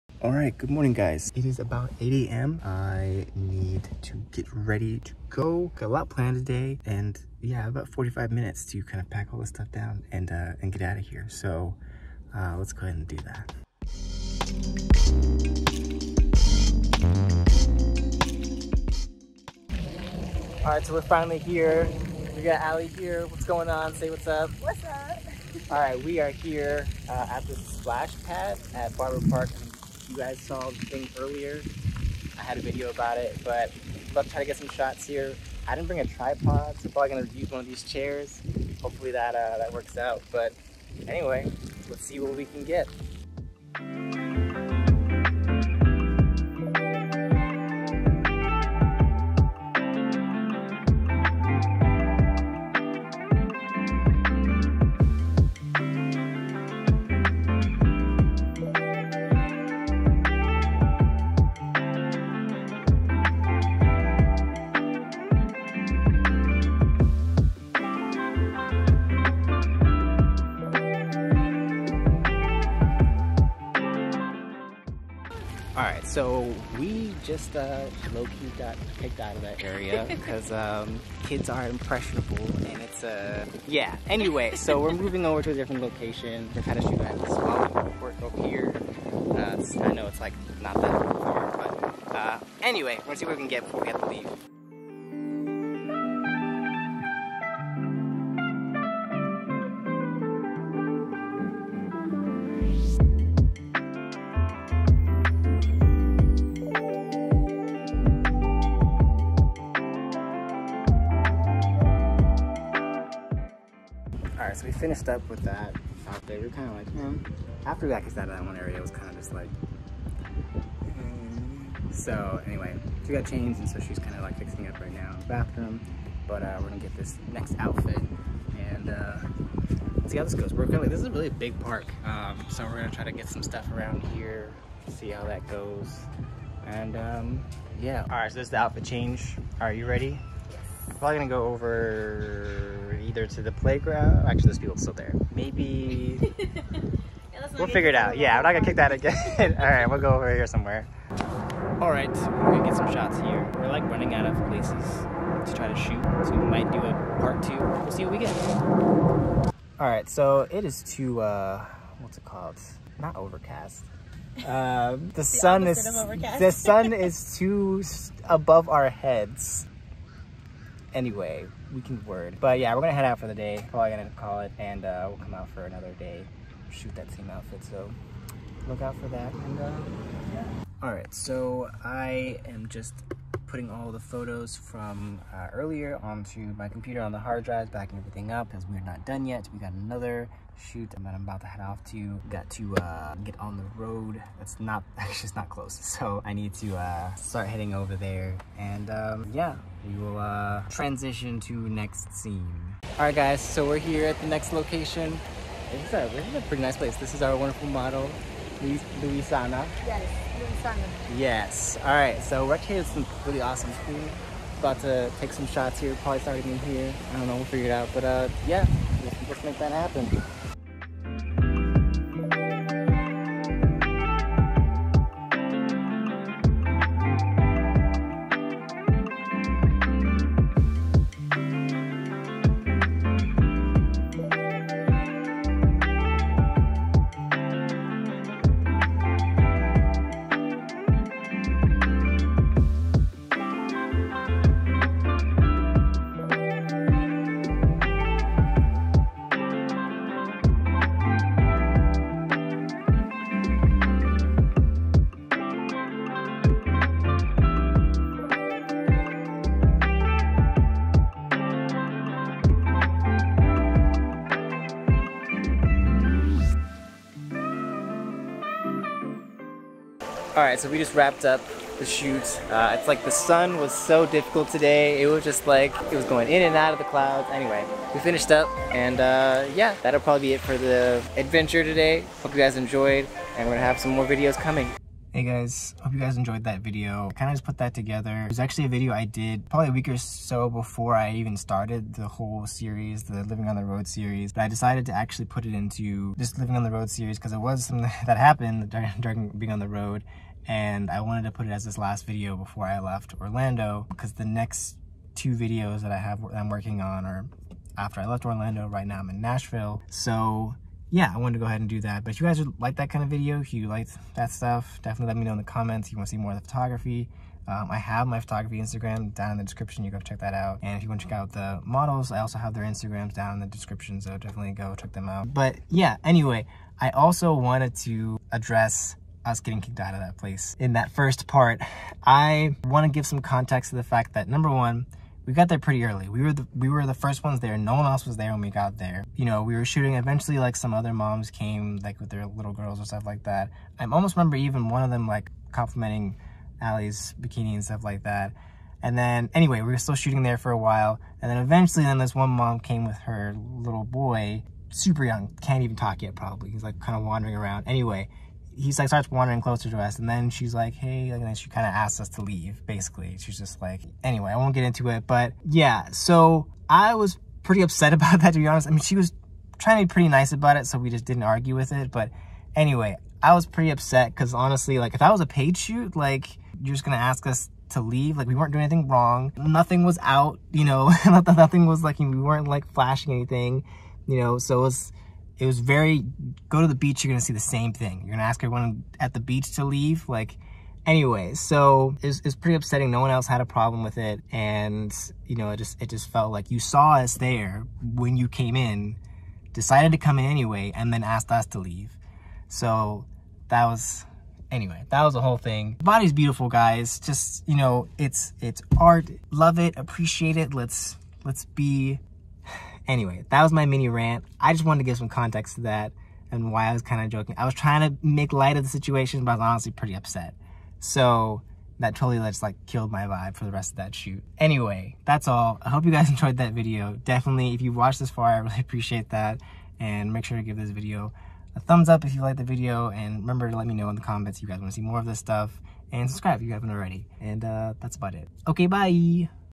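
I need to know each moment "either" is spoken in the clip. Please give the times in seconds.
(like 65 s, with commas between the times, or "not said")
143 s.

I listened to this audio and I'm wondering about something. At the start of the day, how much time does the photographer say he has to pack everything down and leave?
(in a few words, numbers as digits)
45 minutes.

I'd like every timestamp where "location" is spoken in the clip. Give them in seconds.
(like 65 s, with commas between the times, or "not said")
85 s, 204 s.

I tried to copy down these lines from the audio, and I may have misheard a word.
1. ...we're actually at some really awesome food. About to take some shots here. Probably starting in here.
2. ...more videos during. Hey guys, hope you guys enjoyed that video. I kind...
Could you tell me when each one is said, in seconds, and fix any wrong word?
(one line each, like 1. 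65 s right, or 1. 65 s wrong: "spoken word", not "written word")
1. 212 s right
2. 283 s wrong: "coming", not "during".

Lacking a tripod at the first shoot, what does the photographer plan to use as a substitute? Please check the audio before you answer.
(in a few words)
chairs.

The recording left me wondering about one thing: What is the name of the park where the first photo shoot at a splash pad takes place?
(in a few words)
Barber Park.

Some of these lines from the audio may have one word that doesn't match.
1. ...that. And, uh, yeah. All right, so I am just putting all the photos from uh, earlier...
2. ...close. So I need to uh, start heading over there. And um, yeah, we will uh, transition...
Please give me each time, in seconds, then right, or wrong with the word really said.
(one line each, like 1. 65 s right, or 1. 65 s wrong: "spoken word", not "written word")
1. 179 s right
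2. 195 s right.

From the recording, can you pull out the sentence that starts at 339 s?
Eventually, like some other moms came, like with their little girls or stuff like that.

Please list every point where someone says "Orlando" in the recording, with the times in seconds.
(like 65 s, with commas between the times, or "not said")
303 s, 308 s.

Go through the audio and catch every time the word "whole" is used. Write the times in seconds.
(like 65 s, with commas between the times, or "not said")
292 s, 405 s.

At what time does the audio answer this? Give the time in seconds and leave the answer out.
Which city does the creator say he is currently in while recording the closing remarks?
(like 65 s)
309 s.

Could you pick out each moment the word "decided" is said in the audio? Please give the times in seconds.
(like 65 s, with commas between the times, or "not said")
294 s, 399 s.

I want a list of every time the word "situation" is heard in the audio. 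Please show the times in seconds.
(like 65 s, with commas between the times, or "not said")
418 s.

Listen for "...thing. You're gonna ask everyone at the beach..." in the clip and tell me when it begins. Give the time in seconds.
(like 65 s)
387 s.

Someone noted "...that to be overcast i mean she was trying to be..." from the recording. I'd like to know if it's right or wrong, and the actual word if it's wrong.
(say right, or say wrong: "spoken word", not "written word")
wrong: "honest", not "overcast".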